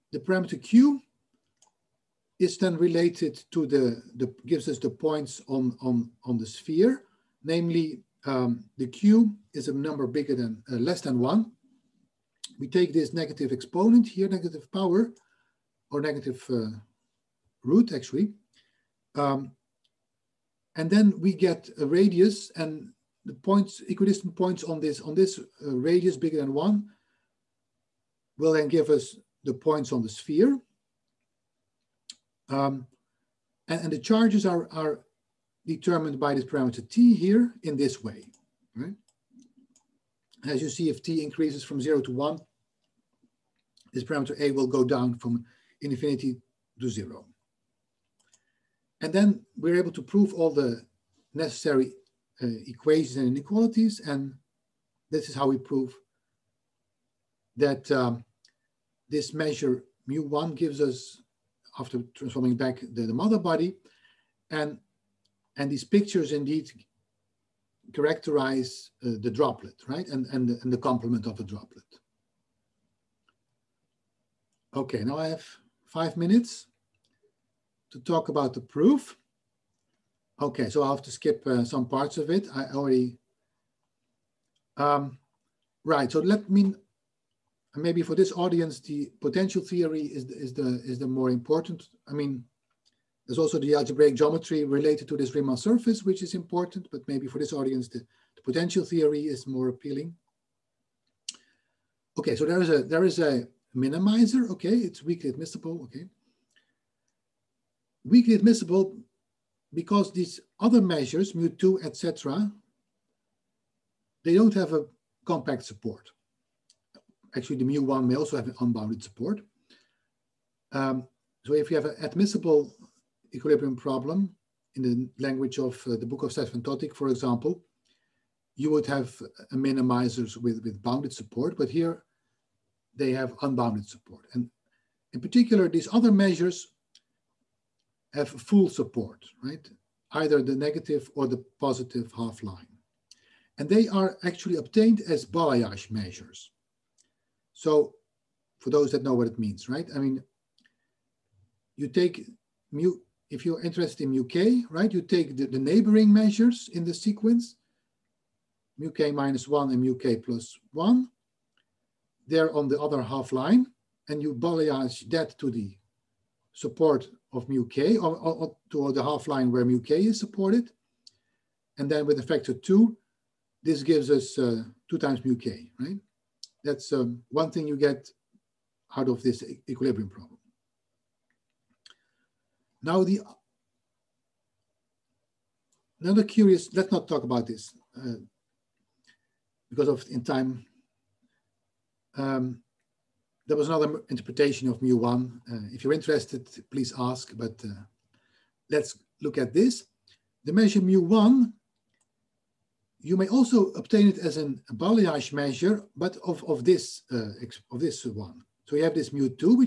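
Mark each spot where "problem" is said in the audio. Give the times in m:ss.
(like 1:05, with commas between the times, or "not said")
2:03, 3:00.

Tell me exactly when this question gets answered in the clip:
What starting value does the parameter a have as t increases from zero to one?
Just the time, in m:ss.
0:45.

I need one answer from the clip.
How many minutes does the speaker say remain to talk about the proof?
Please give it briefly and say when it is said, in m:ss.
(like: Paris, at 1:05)
5, at 1:15.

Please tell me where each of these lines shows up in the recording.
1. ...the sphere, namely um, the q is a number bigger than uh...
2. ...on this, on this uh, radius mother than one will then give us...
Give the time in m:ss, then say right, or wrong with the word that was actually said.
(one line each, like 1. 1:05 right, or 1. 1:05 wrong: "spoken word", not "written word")
1. 0:06 right
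2. 0:24 wrong: "bigger", not "mother".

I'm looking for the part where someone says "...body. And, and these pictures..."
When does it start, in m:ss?
1:03.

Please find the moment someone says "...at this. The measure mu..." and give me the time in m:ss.
3:19.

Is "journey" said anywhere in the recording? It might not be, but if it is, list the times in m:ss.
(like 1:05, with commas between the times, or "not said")
not said.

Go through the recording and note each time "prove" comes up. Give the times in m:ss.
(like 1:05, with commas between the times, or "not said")
0:50, 0:55.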